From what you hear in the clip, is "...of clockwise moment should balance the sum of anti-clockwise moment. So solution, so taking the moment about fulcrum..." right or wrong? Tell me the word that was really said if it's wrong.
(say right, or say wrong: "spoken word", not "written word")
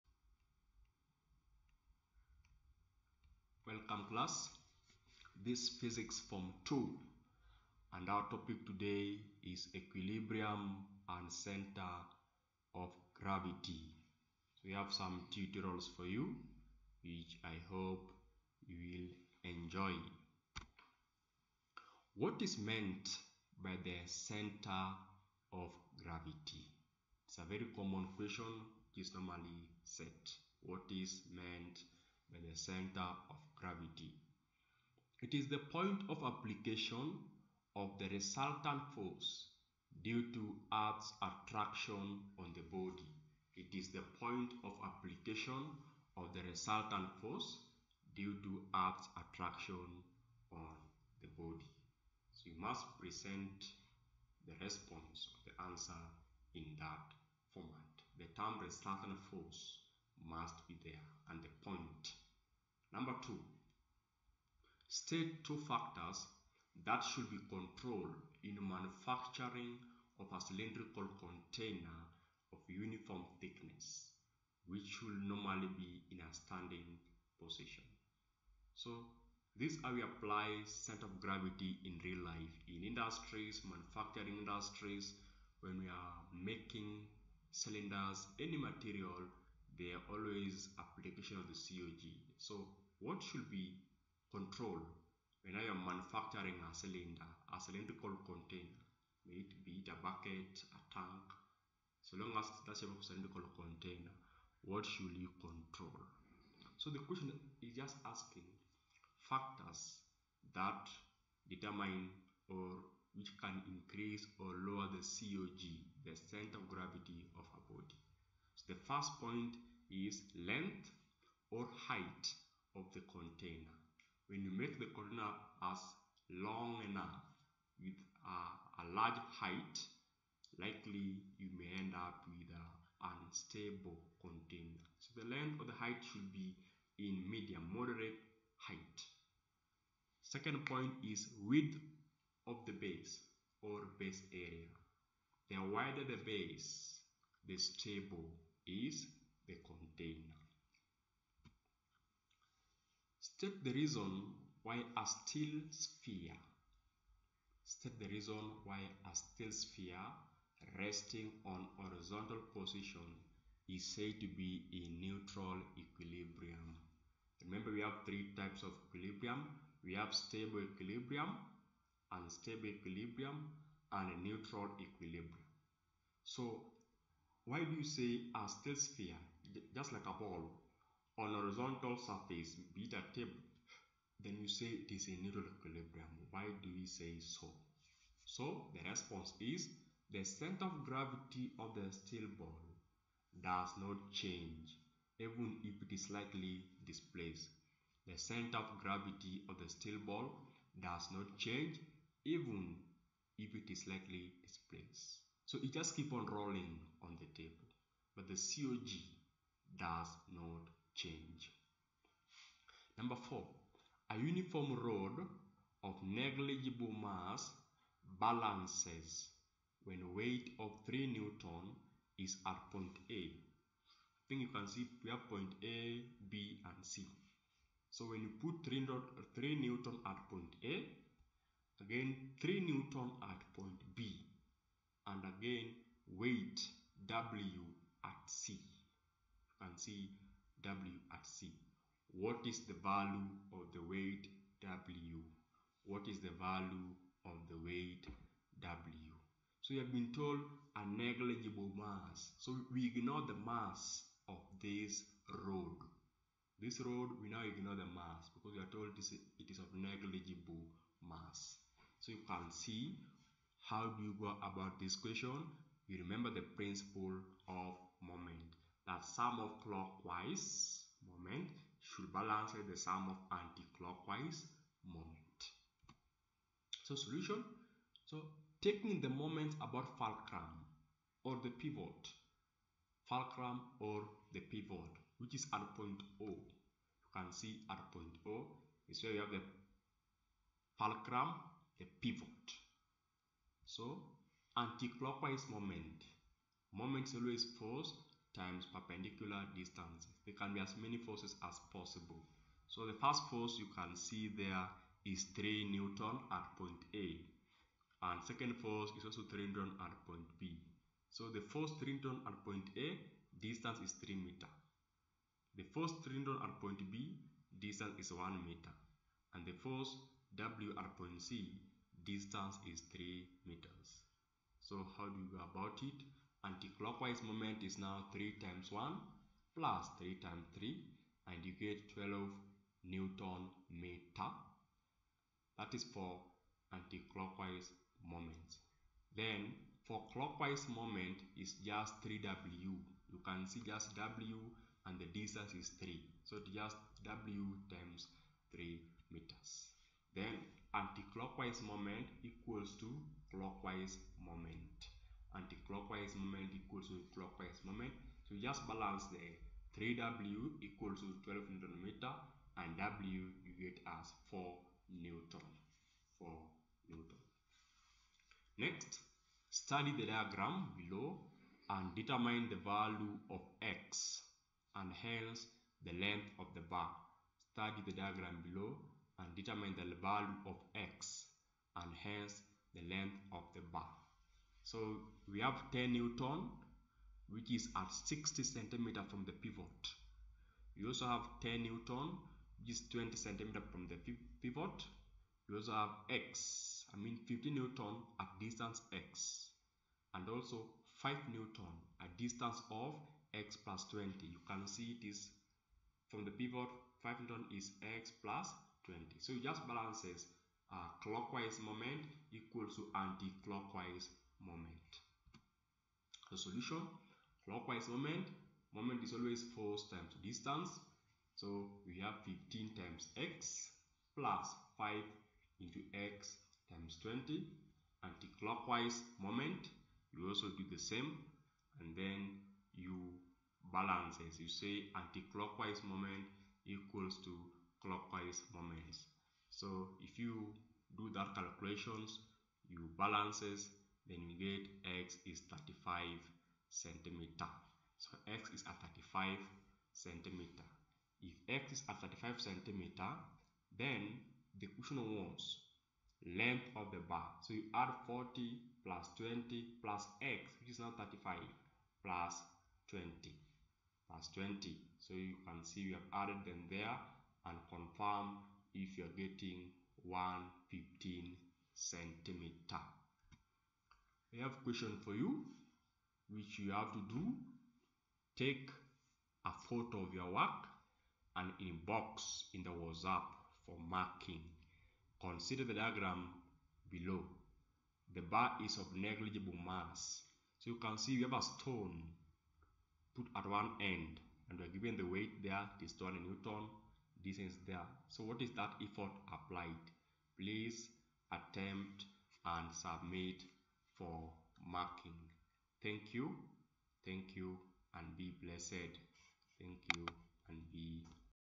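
right.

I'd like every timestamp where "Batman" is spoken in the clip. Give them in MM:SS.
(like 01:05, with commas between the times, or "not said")
not said.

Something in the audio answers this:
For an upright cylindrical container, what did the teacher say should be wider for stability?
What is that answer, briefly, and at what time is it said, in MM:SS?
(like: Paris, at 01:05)
Width of the base, at 02:21.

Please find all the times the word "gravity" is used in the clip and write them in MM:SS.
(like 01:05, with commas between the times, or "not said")
00:13, 00:26, 00:33, 01:21, 01:56, 03:10, 03:18.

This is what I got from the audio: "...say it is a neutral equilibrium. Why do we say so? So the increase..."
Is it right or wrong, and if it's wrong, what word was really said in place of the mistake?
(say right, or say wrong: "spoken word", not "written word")
wrong: "response", not "increase".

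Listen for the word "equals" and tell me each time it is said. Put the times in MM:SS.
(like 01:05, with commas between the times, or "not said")
05:52, 05:56, 06:00, 06:52, 07:16.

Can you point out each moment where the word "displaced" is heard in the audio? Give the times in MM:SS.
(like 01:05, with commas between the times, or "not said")
03:16, 03:24.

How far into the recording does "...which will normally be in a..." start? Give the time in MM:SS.
01:14.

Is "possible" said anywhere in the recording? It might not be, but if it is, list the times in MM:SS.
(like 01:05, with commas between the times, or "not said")
05:01.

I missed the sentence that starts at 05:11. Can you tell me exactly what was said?
So the force 3 Newton at point A, distance is 3 meter.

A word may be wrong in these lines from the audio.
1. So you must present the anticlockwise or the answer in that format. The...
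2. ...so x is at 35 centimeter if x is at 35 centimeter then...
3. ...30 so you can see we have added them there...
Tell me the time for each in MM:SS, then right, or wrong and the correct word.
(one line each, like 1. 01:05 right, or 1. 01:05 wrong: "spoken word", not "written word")
1. 00:52 wrong: "response", not "anticlockwise"
2. 07:27 right
3. 07:44 wrong: "20", not "30".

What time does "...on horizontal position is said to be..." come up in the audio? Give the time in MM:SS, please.
02:41.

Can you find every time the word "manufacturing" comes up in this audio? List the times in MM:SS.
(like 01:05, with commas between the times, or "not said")
01:08, 01:23, 01:35.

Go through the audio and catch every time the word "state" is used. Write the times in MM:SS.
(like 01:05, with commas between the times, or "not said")
01:04, 02:33, 02:37.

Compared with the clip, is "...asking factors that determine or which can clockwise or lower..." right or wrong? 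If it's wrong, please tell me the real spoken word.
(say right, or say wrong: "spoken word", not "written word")
wrong: "increase", not "clockwise".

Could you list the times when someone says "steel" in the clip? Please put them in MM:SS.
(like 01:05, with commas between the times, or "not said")
02:35, 02:39, 02:58, 03:11, 03:19.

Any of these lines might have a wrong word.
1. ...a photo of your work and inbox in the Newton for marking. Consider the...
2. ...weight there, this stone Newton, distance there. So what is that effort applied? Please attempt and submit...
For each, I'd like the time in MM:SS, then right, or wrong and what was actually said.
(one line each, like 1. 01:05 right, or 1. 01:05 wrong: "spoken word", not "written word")
1. 07:59 wrong: "WhatsApp", not "Newton"
2. 08:15 right.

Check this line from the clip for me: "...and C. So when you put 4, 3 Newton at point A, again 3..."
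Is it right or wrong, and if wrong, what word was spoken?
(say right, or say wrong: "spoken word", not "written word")
wrong: "3", not "4".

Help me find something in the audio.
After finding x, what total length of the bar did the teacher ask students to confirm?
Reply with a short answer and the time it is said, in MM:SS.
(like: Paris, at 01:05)
115 centimeter, at 07:50.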